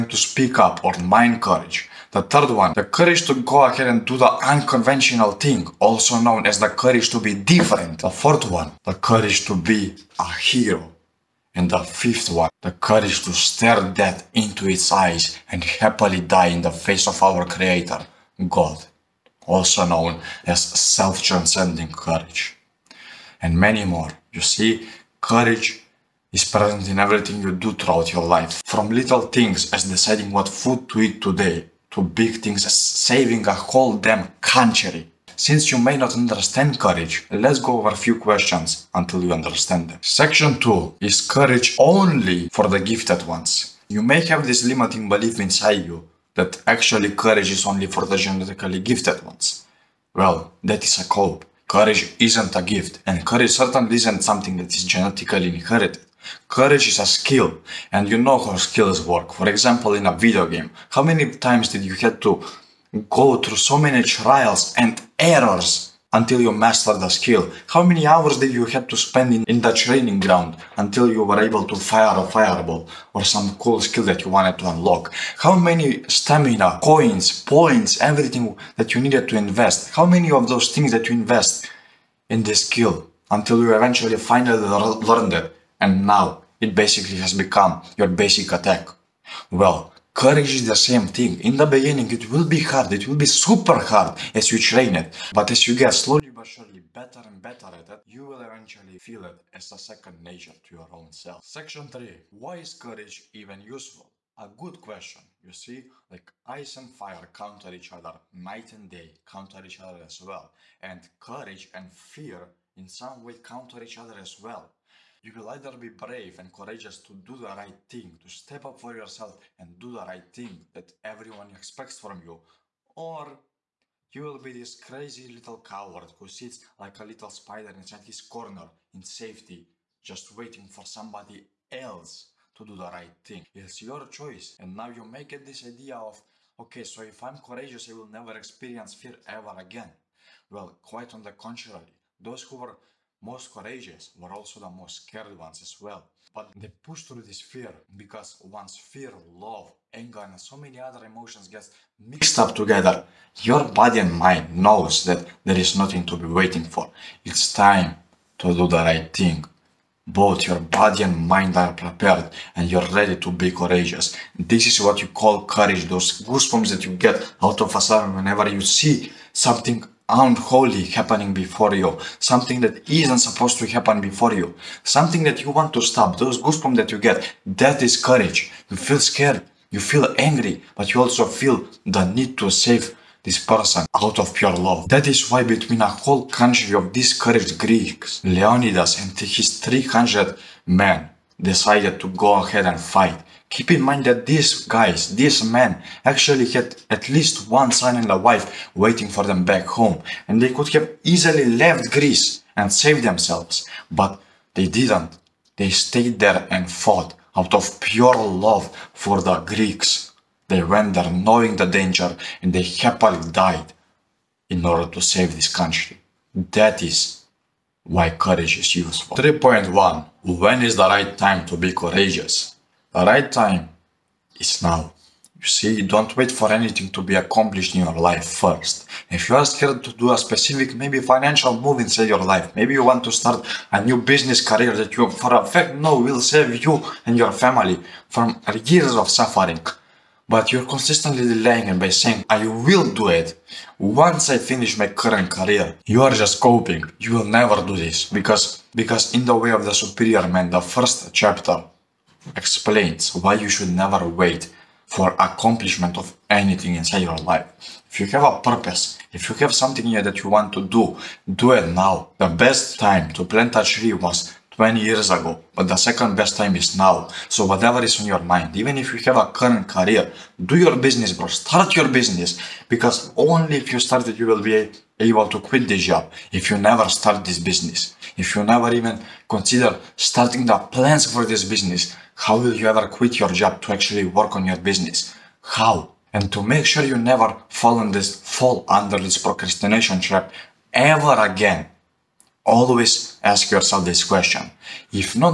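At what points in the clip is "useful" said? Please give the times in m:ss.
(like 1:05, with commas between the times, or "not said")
1:43, 3:38.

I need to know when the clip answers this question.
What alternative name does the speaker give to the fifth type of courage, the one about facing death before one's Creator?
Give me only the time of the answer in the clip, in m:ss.
0:20.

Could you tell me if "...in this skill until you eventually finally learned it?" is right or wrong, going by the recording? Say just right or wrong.
right.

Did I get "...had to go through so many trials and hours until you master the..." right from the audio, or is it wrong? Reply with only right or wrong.
wrong.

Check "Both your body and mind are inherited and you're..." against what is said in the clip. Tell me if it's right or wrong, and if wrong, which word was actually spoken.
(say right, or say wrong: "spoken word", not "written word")
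wrong: "prepared", not "inherited".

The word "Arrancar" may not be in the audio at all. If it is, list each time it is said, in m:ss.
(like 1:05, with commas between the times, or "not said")
not said.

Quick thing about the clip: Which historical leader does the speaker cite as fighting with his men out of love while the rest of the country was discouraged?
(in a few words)
Leonidas.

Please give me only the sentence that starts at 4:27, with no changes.
So whatever is on your mind, even if you have a current career, do your business, bro.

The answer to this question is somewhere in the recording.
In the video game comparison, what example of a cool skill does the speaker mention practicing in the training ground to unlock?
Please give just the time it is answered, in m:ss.
1:12.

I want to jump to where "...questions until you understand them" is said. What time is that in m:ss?
0:38.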